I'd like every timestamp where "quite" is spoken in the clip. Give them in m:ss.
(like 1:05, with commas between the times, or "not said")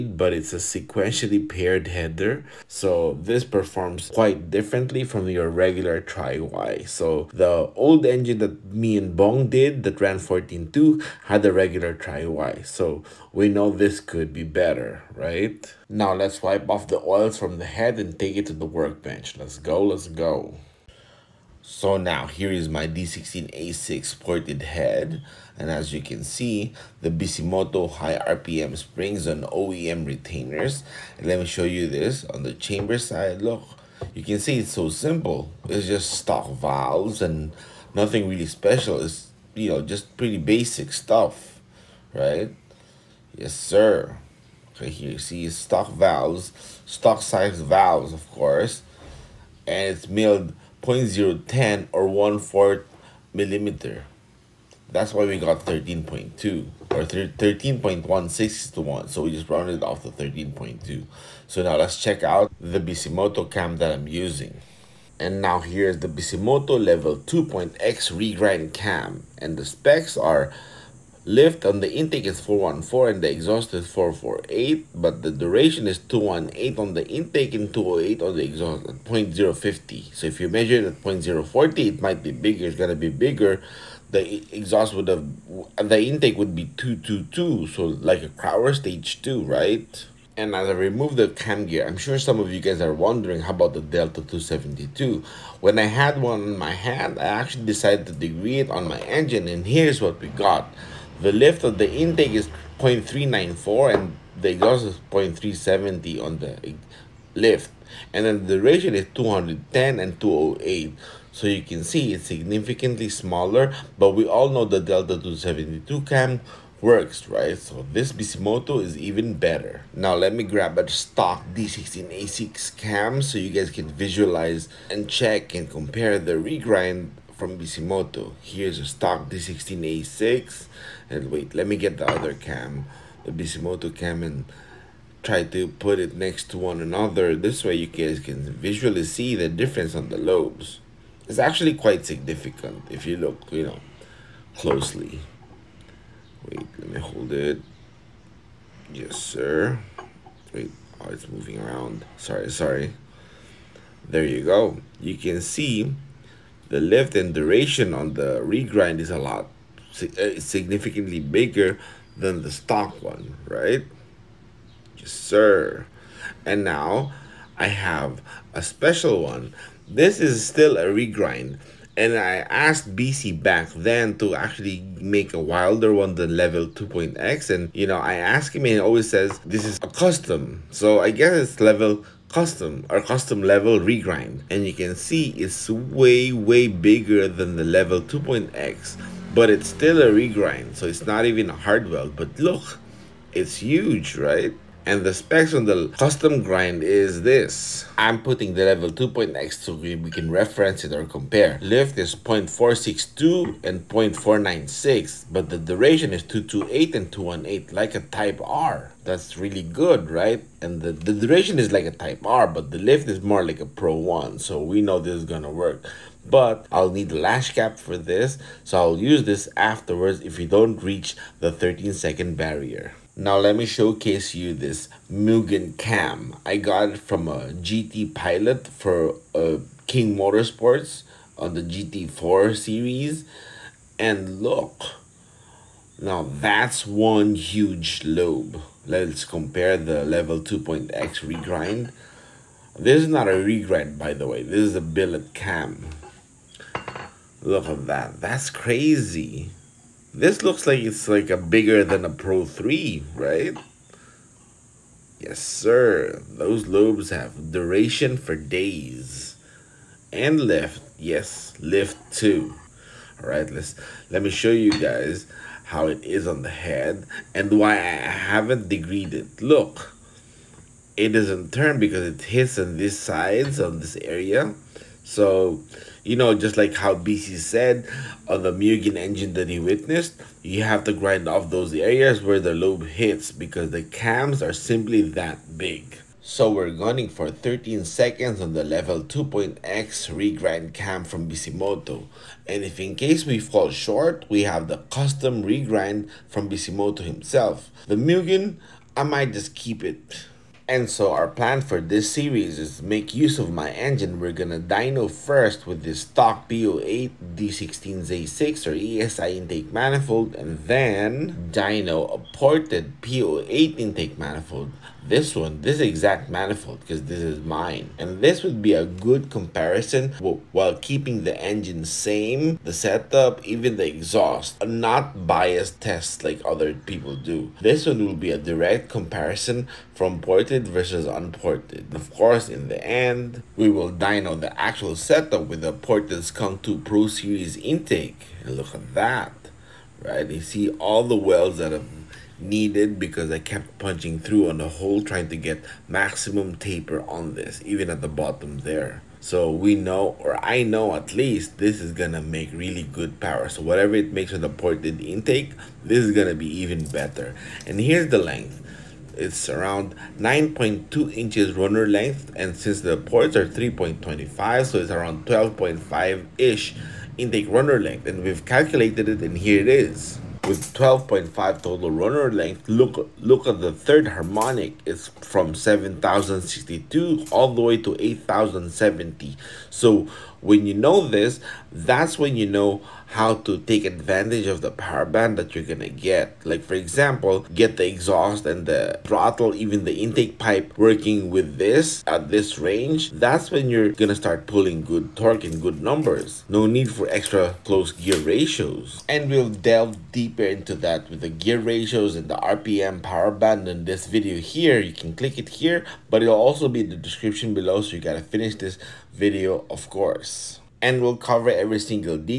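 0:04, 2:21.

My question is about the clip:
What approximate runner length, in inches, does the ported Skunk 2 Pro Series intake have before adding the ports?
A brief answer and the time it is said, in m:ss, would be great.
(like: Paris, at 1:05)
9.2 inches, at 6:00.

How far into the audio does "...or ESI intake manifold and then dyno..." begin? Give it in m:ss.
5:08.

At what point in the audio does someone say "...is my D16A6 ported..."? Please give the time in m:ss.
0:22.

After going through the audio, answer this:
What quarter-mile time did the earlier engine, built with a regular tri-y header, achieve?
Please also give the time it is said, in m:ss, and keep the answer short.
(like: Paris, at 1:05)
14.2, at 0:10.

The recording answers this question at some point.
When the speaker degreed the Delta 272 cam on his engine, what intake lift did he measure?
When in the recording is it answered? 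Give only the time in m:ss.
1:42.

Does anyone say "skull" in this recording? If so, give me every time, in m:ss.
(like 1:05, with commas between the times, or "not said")
not said.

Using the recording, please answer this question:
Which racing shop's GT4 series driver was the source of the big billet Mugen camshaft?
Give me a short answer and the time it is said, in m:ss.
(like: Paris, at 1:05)
King Motorsports, at 3:49.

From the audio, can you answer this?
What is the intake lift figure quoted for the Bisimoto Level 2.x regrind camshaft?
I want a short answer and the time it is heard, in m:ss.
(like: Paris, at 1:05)
414, at 1:12.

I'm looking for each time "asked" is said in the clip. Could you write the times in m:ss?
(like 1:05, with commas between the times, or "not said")
2:52, 2:58.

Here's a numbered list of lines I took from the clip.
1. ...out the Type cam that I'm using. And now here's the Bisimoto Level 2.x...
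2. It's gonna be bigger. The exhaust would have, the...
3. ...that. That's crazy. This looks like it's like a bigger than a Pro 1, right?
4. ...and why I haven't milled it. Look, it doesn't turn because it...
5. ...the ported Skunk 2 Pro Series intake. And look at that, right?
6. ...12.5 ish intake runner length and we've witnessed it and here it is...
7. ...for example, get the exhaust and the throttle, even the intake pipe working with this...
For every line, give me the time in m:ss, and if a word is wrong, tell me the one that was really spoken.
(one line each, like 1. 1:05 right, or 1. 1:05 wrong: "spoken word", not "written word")
1. 1:02 wrong: "Bisimoto", not "Type"
2. 1:22 right
3. 4:07 wrong: "3", not "1"
4. 4:27 wrong: "degreed", not "milled"
5. 5:35 right
6. 6:05 wrong: "calculated", not "witnessed"
7. 6:26 right.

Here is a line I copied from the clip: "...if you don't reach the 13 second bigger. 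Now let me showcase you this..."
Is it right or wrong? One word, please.
wrong.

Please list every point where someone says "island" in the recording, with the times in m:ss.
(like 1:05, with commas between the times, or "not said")
not said.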